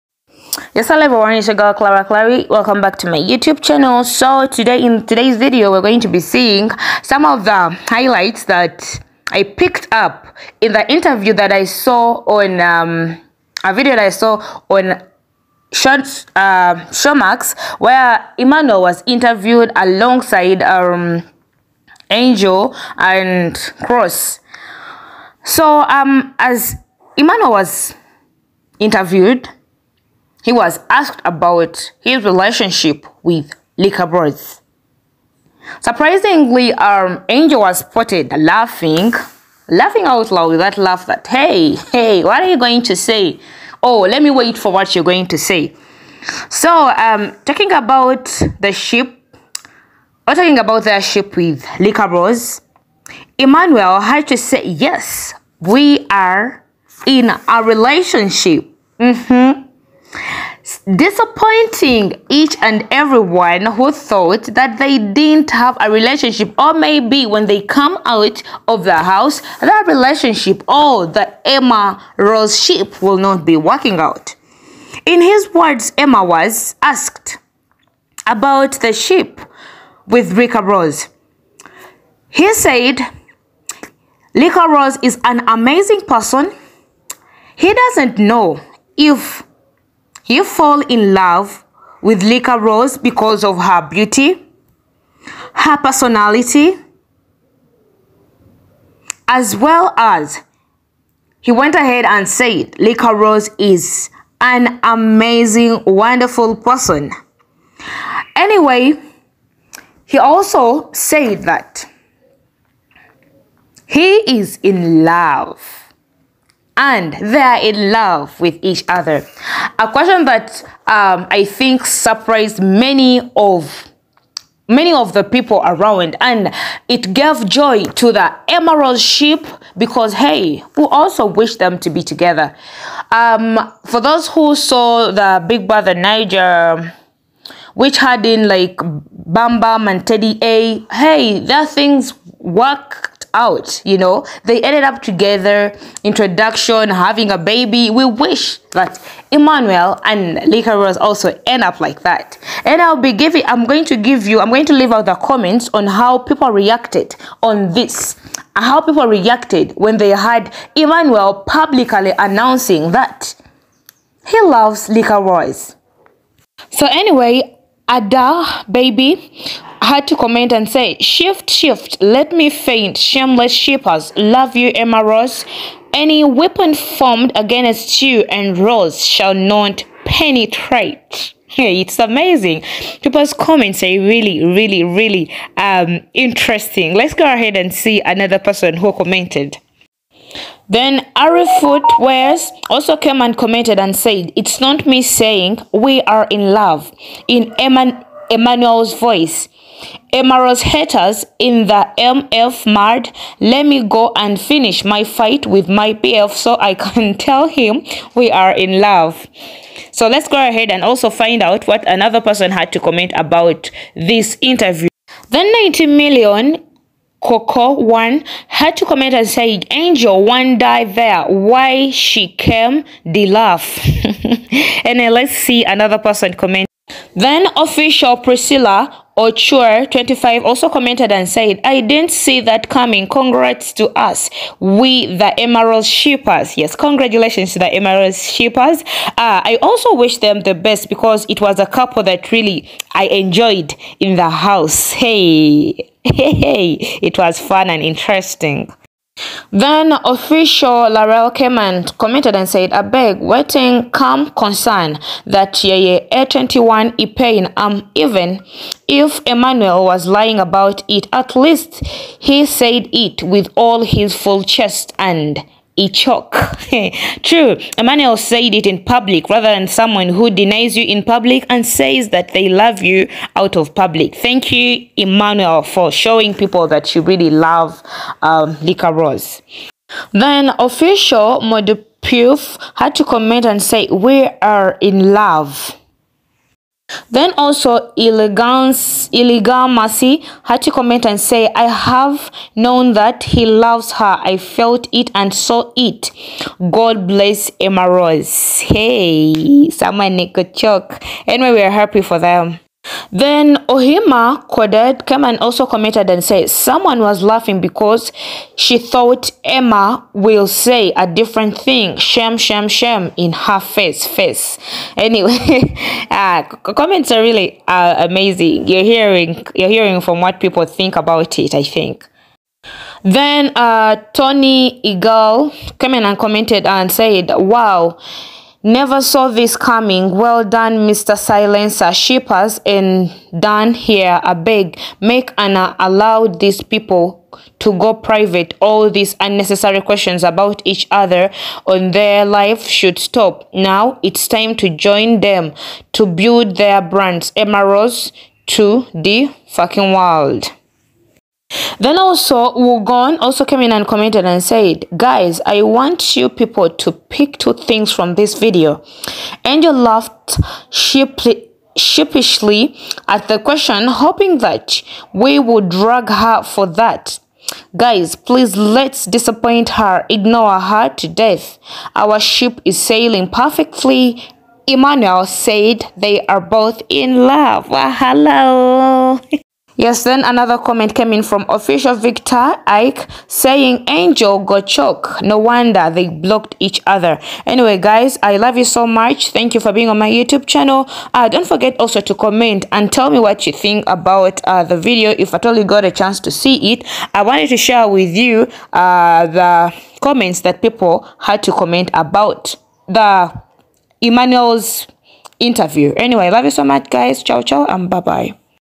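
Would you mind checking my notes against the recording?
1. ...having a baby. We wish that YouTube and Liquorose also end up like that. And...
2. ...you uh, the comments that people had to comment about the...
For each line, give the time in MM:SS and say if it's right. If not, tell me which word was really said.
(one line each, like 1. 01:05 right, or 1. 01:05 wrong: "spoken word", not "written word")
1. 02:26 wrong: "Emmanuel", not "YouTube"
2. 06:38 right.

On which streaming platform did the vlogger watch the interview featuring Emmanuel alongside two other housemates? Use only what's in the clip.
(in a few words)
Showmax.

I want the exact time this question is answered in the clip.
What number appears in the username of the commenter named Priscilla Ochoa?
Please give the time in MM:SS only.
03:49.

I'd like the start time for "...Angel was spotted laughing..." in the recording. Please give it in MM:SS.
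00:37.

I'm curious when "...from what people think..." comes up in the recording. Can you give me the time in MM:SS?
05:20.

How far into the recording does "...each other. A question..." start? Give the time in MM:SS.
01:58.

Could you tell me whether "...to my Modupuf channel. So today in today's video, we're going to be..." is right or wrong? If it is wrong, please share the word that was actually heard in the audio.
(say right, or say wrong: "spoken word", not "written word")
wrong: "YouTube", not "Modupuf".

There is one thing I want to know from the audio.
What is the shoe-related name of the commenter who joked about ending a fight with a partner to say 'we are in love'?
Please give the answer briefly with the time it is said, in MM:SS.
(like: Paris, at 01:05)
Ari Footwears, at 03:11.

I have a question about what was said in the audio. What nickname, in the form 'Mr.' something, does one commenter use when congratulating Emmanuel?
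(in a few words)
Silencer.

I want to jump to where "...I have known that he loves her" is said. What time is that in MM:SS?
04:51.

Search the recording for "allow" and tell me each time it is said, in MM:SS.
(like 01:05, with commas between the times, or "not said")
05:35.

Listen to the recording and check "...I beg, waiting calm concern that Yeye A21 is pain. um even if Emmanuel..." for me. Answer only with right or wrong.
right.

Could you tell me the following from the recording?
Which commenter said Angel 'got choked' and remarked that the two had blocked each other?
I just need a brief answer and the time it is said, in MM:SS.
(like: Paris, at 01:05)
Victor Ike, at 06:21.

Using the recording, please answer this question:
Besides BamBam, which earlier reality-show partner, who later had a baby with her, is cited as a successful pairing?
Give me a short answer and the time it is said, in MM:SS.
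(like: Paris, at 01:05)
Teddy A, at 02:20.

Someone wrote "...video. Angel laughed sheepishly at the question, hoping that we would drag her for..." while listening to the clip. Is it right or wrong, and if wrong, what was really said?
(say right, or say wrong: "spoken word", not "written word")
right.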